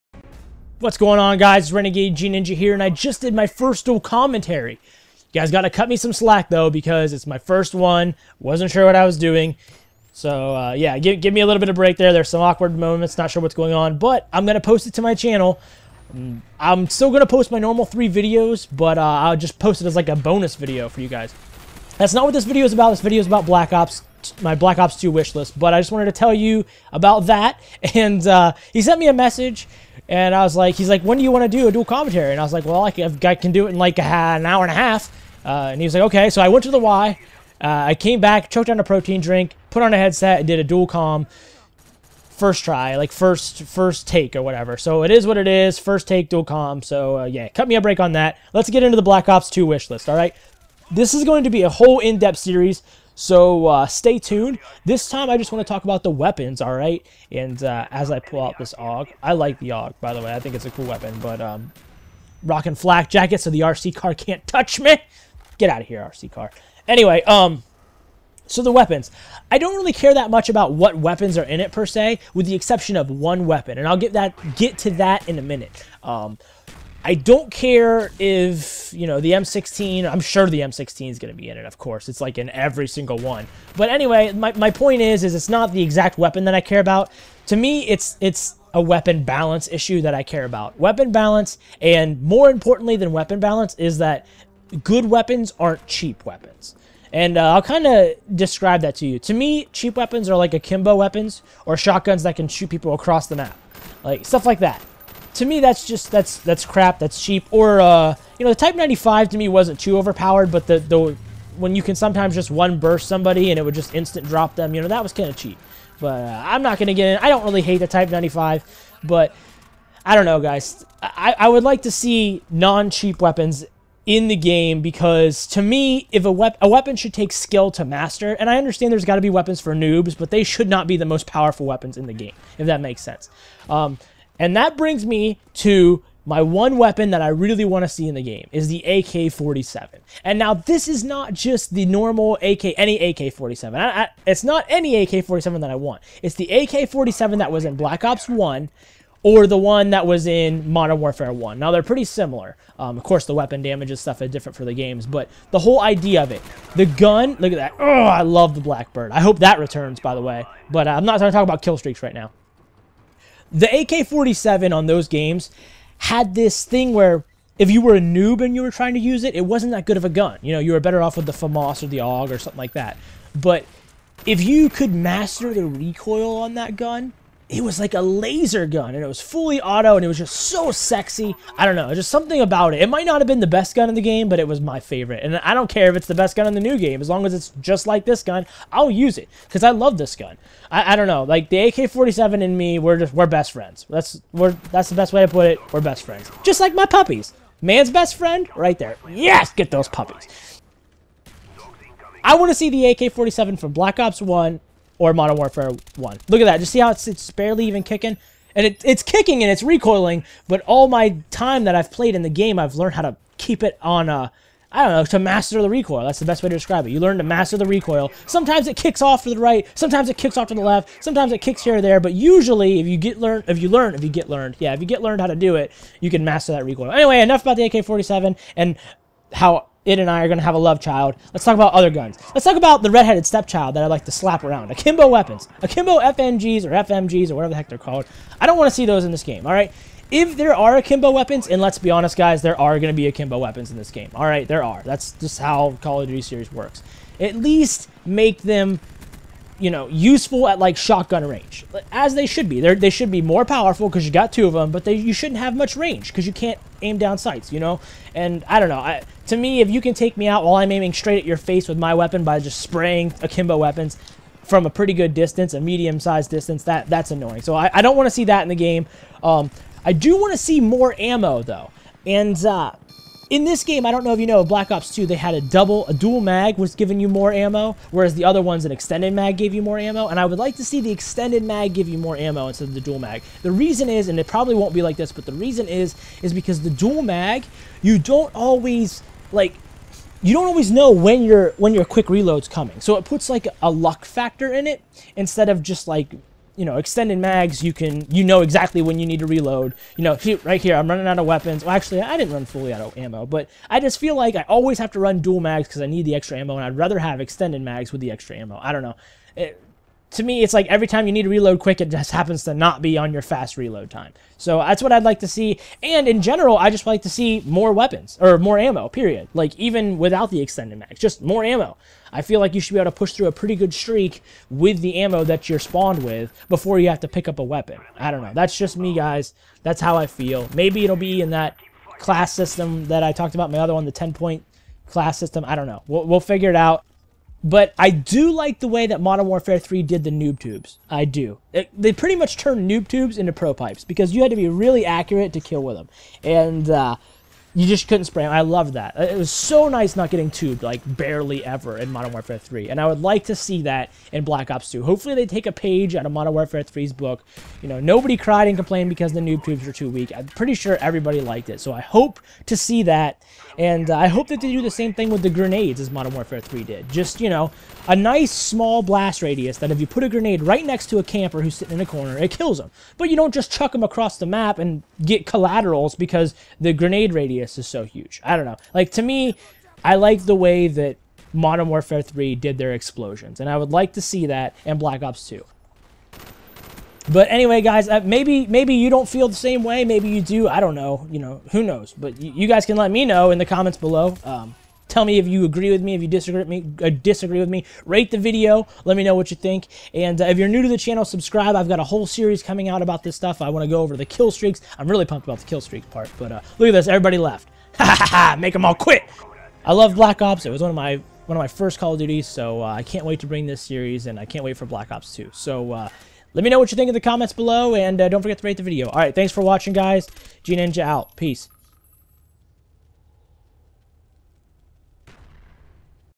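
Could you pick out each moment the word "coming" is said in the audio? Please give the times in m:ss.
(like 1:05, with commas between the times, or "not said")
4:52, 6:42.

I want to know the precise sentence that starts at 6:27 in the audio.
But anyway, guys, uh, maybe maybe you don't feel the same way.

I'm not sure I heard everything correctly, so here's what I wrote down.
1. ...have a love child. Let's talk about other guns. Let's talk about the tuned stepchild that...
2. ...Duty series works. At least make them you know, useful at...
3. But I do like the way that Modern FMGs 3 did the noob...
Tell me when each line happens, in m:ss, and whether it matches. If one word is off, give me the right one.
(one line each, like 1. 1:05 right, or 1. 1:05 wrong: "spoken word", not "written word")
1. 3:50 wrong: "redheaded", not "tuned"
2. 4:06 right
3. 5:37 wrong: "Warfare", not "FMGs".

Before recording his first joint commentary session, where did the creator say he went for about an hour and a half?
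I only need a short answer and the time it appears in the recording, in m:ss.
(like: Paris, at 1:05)
the Y, at 0:36.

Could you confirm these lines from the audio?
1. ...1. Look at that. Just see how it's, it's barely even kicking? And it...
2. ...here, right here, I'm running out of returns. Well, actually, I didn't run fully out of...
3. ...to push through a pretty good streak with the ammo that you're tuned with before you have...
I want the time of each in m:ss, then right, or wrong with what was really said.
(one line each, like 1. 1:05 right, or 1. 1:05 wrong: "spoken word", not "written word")
1. 3:25 right
2. 5:00 wrong: "weapons", not "returns"
3. 5:22 wrong: "spawned", not "tuned".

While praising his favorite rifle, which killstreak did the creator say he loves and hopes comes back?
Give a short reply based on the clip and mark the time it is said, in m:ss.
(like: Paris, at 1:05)
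Blackbird, at 2:38.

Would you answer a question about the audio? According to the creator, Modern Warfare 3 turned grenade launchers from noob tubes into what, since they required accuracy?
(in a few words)
pro pipes.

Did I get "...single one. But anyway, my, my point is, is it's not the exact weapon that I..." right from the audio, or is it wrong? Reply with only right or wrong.
right.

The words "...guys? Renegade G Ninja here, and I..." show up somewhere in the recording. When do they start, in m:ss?
0:01.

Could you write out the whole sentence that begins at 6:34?
Um, Tell me if you agree with me, if you disagree with me, uh, disagree with me.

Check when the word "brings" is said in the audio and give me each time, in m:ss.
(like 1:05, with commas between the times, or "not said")
2:14, 6:53.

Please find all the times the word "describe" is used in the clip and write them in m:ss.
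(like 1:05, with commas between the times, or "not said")
1:38, 3:36.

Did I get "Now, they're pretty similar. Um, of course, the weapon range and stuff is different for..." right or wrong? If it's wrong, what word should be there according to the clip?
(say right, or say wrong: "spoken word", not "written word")
wrong: "damage", not "range".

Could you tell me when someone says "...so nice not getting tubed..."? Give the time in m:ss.
5:49.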